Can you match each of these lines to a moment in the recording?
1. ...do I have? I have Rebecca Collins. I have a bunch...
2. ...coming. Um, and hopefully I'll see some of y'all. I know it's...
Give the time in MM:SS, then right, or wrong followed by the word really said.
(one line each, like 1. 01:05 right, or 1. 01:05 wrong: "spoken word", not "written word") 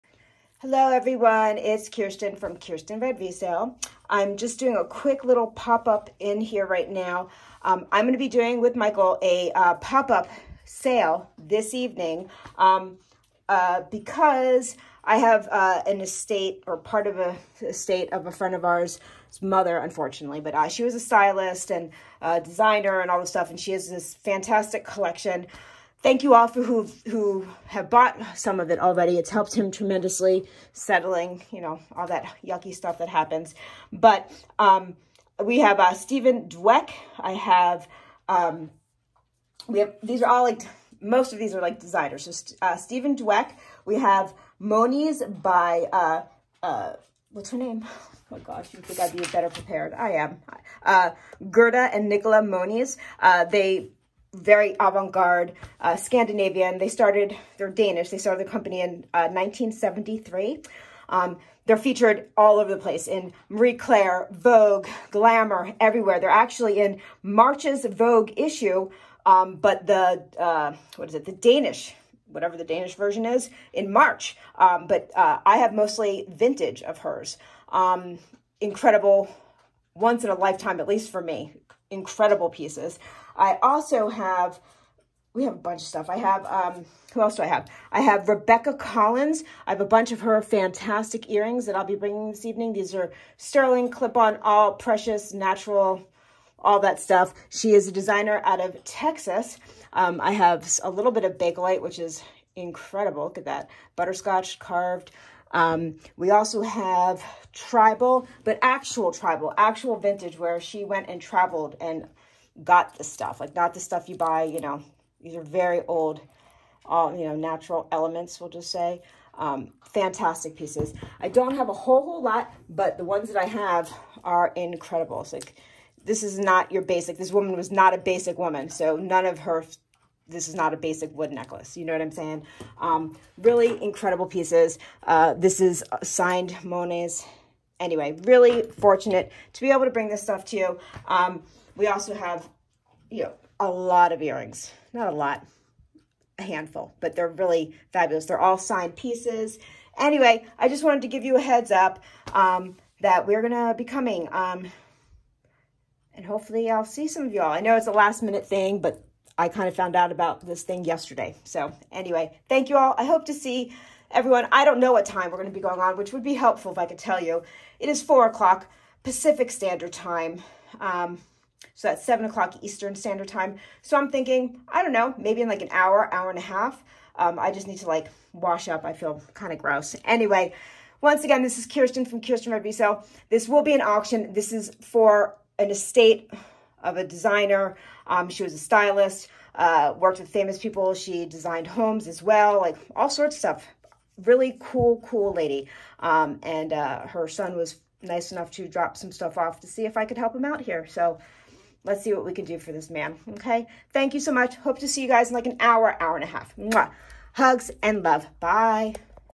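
1. 01:27 right
2. 02:33 right.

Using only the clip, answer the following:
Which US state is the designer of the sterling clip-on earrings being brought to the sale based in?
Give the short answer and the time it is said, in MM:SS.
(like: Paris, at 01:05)
Texas, at 01:38.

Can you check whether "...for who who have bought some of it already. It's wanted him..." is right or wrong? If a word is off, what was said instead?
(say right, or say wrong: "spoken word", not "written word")
wrong: "helped", not "wanted".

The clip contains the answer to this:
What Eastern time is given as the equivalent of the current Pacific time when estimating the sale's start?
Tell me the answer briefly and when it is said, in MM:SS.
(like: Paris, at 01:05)
7:00, at 02:52.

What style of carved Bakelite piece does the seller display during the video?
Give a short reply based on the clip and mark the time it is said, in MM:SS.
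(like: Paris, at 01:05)
Butterscotch carved, at 01:43.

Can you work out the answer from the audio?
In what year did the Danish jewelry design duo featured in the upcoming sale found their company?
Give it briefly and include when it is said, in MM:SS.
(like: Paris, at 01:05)
1973, at 00:59.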